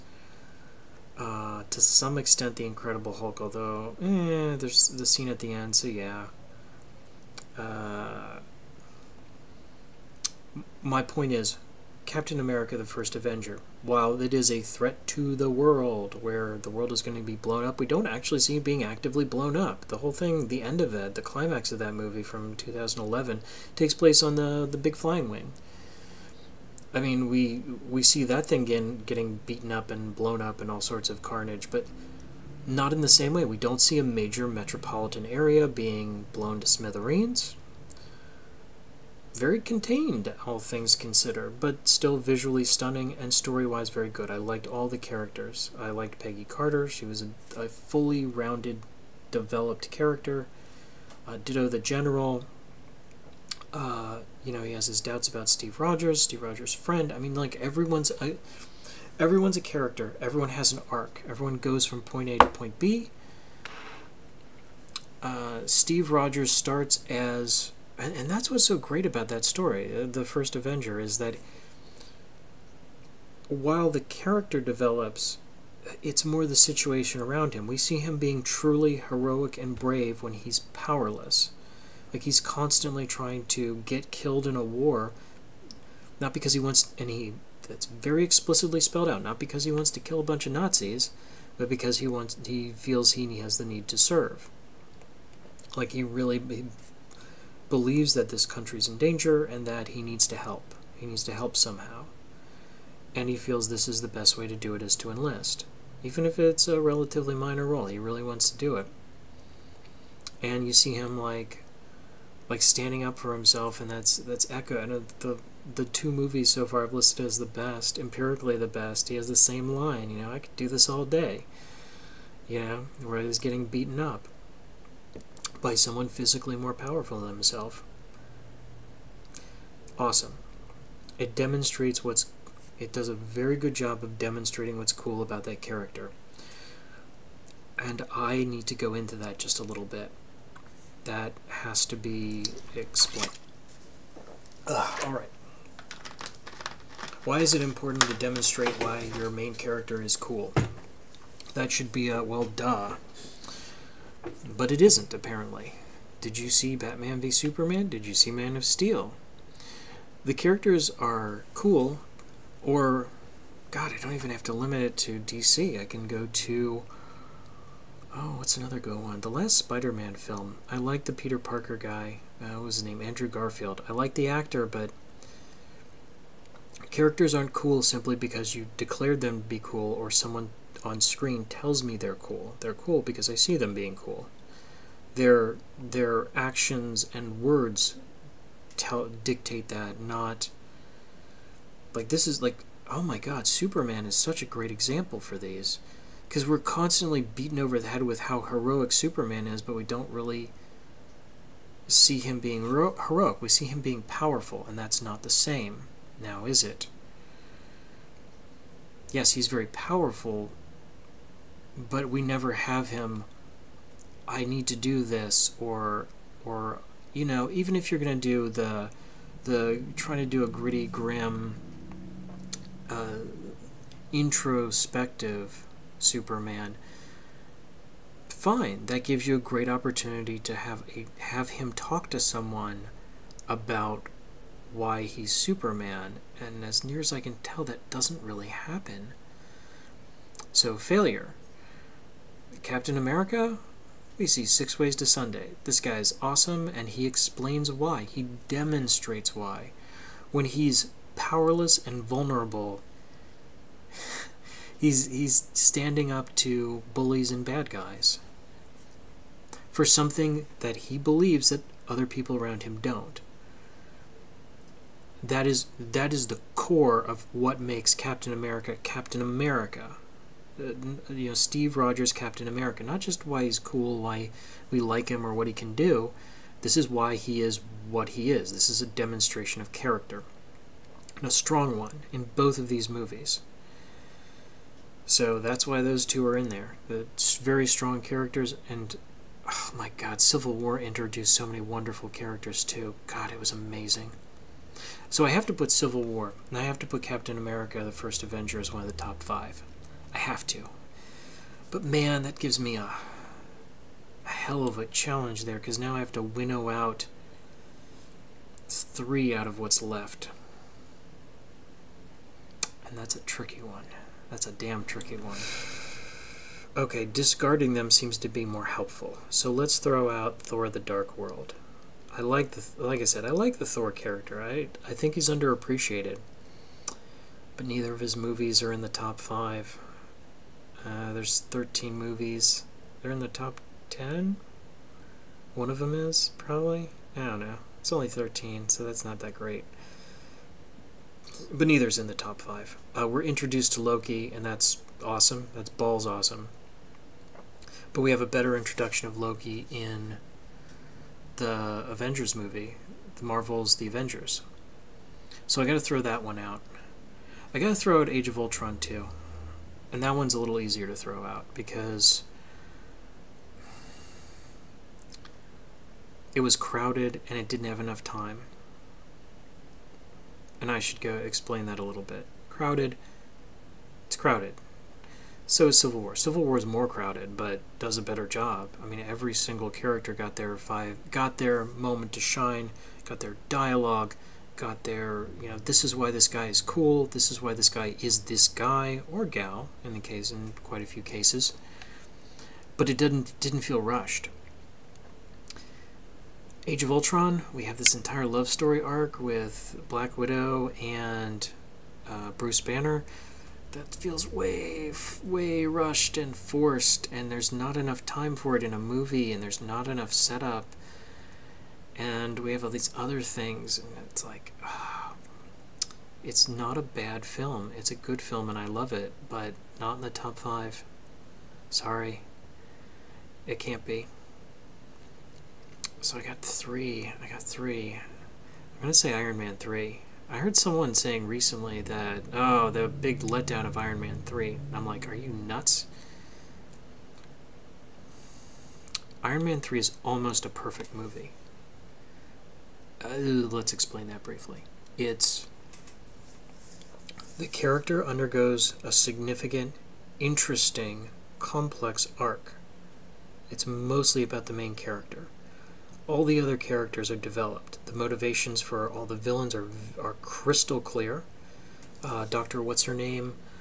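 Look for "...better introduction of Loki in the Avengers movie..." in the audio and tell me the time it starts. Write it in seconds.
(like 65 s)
348 s.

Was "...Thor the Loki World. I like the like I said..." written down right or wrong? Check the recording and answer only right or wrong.
wrong.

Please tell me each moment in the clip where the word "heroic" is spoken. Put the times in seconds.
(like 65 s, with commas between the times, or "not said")
78 s, 198 s, 202 s.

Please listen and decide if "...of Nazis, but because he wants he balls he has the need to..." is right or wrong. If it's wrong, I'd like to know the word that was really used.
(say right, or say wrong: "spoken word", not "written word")
wrong: "feels", not "balls".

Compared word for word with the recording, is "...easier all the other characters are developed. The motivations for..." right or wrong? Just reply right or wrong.
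wrong.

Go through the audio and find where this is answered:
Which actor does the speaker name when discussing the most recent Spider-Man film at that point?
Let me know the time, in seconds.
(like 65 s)
173 s.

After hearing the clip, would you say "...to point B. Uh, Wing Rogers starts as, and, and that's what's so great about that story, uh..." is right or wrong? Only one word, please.
wrong.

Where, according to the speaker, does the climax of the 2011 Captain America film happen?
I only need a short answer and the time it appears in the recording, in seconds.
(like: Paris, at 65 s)
The Big Flying Wing, at 24 s.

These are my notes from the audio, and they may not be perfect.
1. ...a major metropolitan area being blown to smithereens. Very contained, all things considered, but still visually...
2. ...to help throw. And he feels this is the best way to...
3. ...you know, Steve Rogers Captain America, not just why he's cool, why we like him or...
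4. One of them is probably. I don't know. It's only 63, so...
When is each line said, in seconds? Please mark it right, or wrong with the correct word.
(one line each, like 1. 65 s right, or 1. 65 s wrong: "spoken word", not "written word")
1. 33 s right
2. 101 s wrong: "somehow", not "throw"
3. 271 s right
4. 335 s wrong: "13", not "63".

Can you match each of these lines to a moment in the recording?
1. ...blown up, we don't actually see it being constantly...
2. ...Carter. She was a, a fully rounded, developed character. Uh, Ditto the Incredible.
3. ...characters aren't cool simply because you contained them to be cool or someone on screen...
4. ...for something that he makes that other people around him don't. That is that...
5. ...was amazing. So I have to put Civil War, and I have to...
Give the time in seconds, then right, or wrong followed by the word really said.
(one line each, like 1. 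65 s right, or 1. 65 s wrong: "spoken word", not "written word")
1. 17 s wrong: "actively", not "constantly"
2. 46 s wrong: "General", not "Incredible"
3. 176 s wrong: "declared", not "contained"
4. 259 s wrong: "believes", not "makes"
5. 293 s right.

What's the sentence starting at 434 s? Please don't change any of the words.
And I'm like, are you nuts?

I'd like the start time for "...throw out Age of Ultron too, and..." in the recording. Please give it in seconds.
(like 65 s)
357 s.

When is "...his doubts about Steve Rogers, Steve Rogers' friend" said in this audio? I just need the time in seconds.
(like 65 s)
54 s.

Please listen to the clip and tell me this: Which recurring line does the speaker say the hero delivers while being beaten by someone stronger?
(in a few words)
I could do this all day.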